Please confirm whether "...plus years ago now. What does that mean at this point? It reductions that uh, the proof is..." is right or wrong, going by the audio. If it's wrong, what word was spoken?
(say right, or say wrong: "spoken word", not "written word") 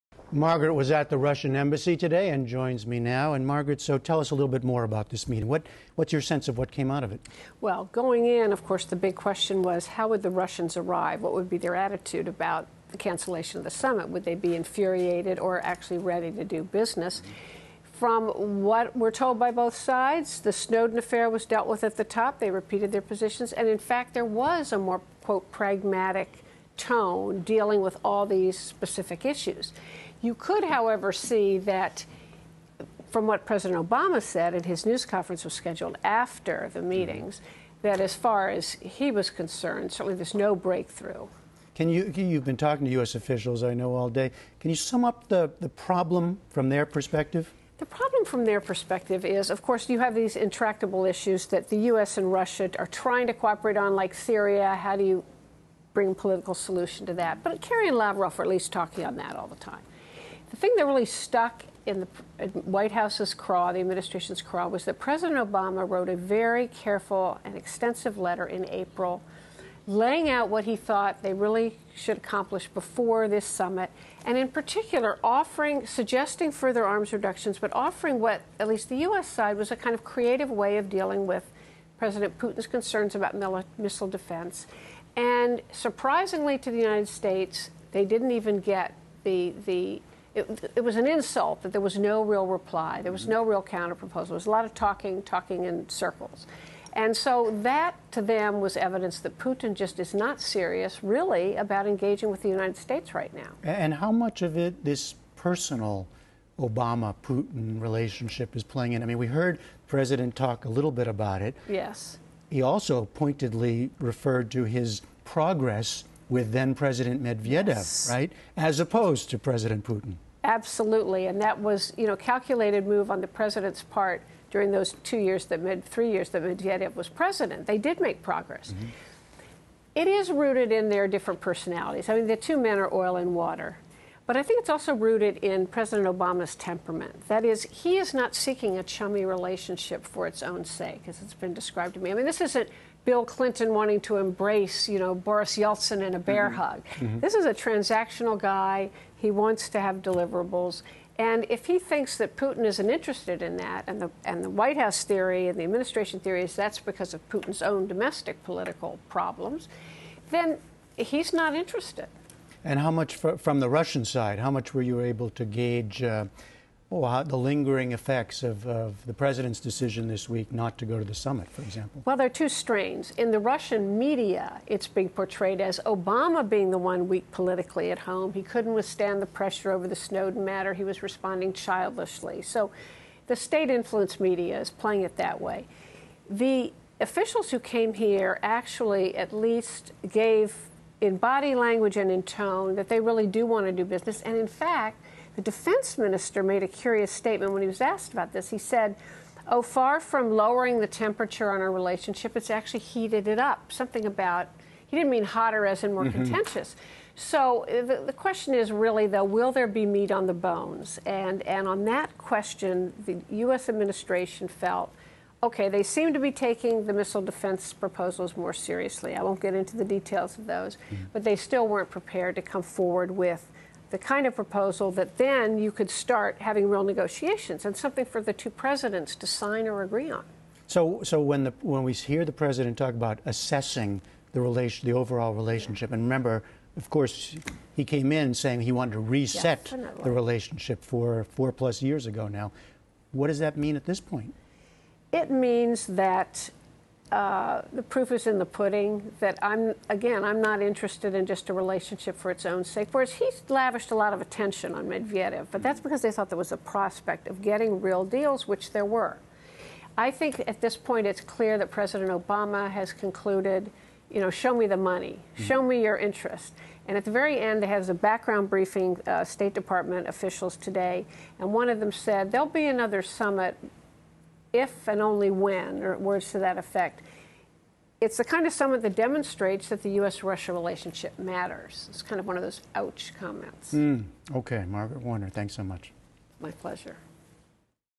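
wrong: "means", not "reductions".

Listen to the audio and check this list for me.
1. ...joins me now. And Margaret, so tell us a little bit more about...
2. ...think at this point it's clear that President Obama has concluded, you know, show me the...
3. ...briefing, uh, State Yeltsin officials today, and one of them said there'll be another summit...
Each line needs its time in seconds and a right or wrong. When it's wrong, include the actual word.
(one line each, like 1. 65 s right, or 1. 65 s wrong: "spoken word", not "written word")
1. 2 s right
2. 260 s right
3. 268 s wrong: "Department", not "Yeltsin".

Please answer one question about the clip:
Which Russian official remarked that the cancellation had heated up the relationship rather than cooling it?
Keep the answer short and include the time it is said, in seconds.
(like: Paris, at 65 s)
the defense minister, at 195 s.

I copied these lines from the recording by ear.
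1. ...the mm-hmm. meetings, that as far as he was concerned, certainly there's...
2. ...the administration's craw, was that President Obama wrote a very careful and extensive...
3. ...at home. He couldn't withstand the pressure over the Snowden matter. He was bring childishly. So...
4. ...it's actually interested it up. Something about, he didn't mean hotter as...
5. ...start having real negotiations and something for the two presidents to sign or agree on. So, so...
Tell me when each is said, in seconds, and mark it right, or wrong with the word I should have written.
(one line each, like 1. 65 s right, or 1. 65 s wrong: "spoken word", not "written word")
1. 36 s right
2. 63 s right
3. 177 s wrong: "responding", not "bring"
4. 202 s wrong: "heated", not "interested"
5. 225 s right.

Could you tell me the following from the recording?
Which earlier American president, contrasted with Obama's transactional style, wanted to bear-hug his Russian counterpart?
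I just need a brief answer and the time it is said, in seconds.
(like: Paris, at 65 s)
Bill Clinton, at 143 s.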